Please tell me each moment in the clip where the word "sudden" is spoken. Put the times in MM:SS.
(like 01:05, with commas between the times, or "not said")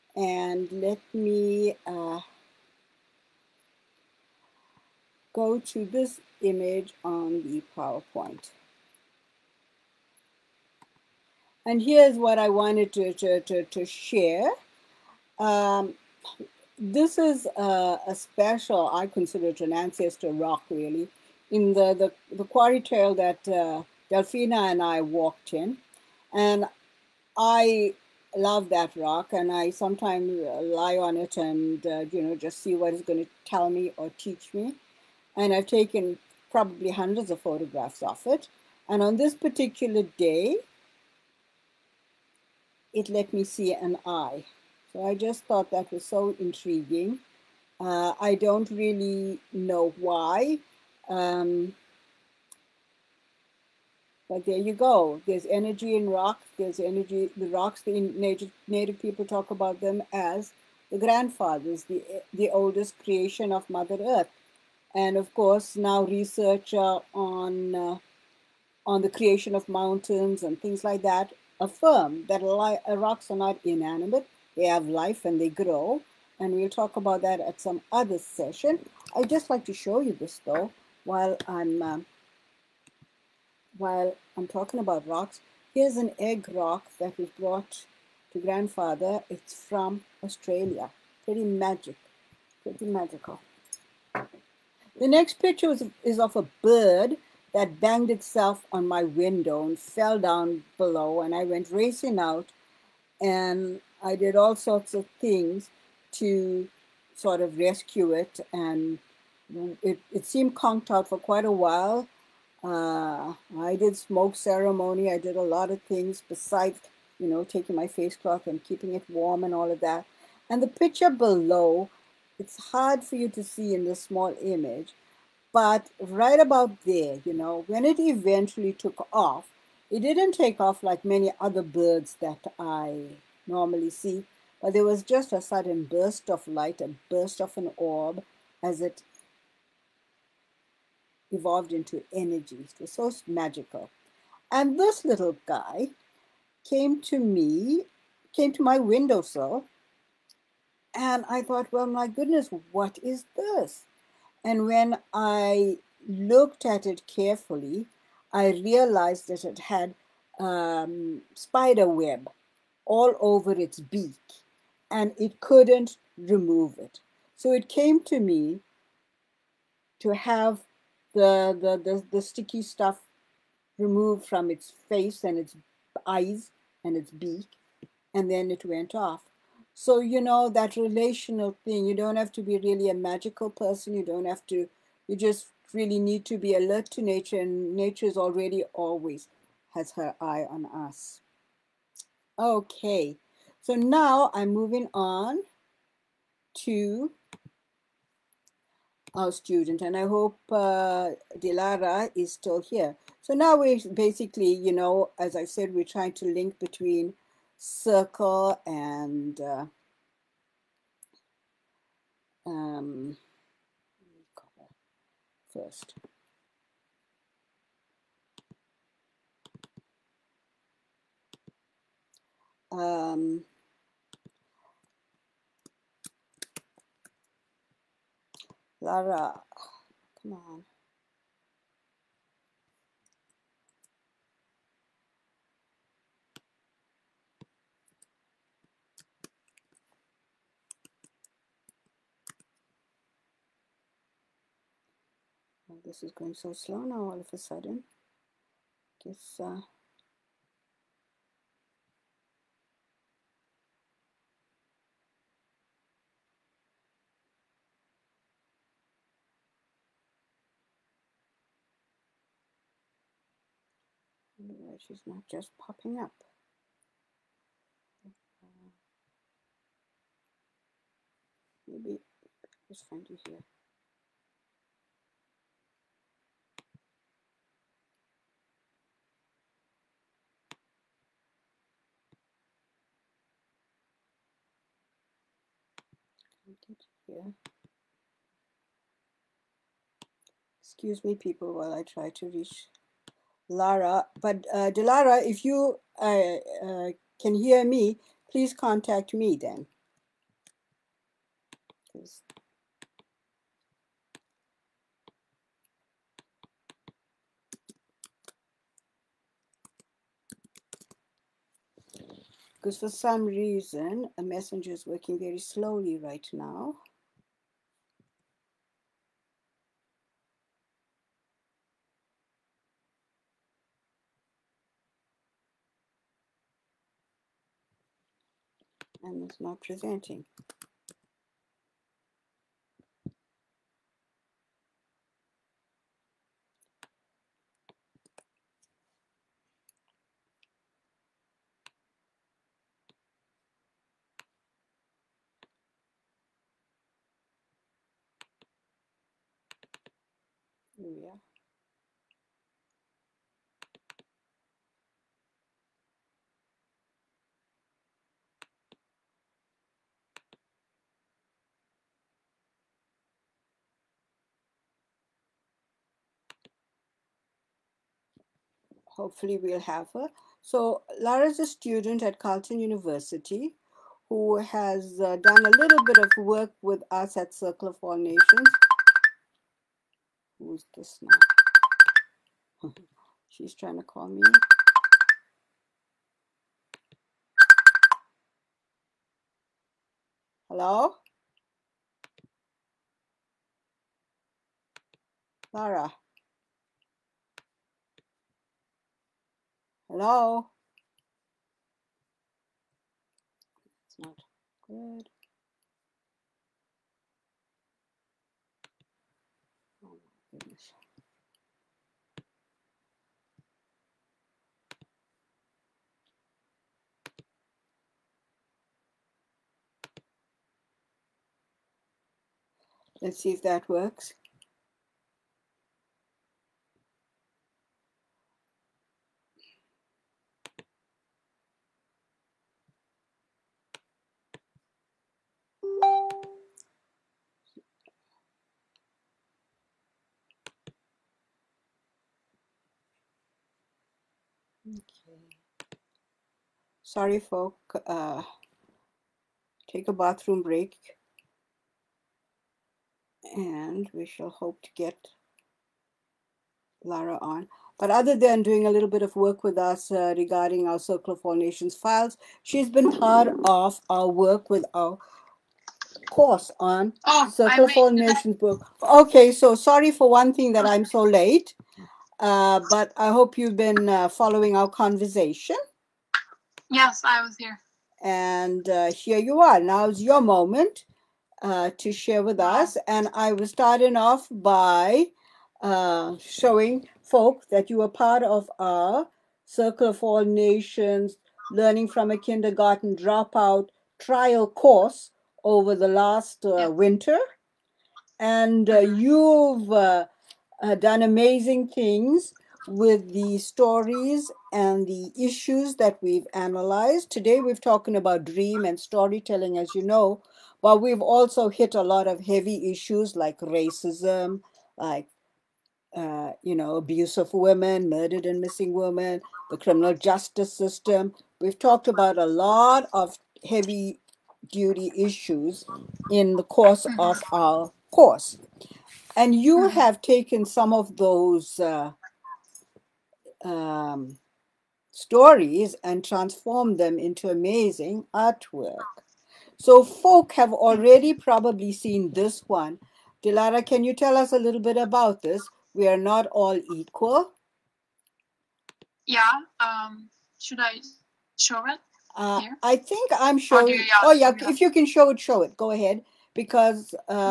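02:15, 04:07.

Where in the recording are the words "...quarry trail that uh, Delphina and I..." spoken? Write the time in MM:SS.
00:22.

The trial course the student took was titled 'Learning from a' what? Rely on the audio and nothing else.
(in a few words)
Kindergarten Dropout.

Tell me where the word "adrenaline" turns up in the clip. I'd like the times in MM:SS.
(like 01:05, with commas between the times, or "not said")
not said.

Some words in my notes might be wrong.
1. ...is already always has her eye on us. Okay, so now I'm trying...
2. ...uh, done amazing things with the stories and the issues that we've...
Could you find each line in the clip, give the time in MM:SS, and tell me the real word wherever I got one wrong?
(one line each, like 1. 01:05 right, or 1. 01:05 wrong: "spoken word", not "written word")
1. 03:08 wrong: "moving", not "trying"
2. 08:20 right.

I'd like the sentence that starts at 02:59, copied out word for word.
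So, you know, that relational thing, you don't have to be really a magical person.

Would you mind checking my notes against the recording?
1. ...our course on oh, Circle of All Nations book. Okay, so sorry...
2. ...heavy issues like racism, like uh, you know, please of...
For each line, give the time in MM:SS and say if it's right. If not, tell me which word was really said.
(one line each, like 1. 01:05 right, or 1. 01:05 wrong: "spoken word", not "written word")
1. 07:44 right
2. 08:32 wrong: "abuse", not "please".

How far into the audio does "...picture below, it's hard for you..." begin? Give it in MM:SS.
02:00.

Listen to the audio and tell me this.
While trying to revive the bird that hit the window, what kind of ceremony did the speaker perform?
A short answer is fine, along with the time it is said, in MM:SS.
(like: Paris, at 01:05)
smoke ceremony, at 01:53.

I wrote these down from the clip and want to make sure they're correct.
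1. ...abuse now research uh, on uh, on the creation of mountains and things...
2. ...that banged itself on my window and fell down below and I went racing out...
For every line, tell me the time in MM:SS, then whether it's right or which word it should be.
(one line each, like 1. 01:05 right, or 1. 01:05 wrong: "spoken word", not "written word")
1. 01:05 wrong: "course", not "abuse"
2. 01:37 right.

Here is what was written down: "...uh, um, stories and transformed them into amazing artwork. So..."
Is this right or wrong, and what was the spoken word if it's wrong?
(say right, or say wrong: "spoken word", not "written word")
right.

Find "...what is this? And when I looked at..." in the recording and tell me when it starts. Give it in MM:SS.
02:32.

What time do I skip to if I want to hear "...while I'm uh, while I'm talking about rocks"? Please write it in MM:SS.
01:21.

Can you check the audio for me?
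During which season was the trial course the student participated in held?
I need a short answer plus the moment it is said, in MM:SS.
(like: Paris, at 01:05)
winter, at 08:16.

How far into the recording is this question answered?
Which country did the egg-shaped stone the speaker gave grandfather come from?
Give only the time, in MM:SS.
01:30.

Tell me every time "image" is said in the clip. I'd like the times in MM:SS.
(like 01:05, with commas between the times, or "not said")
00:06, 02:04.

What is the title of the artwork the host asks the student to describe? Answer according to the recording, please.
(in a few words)
We are not all equal.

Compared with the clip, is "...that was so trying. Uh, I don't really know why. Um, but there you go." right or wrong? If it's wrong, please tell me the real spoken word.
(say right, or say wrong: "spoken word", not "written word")
wrong: "intriguing", not "trying".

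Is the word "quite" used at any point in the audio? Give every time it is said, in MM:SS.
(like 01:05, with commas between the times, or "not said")
01:51.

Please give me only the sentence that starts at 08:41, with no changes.
We've talked about a lot of heavy duty issues in the course of mm-hmm.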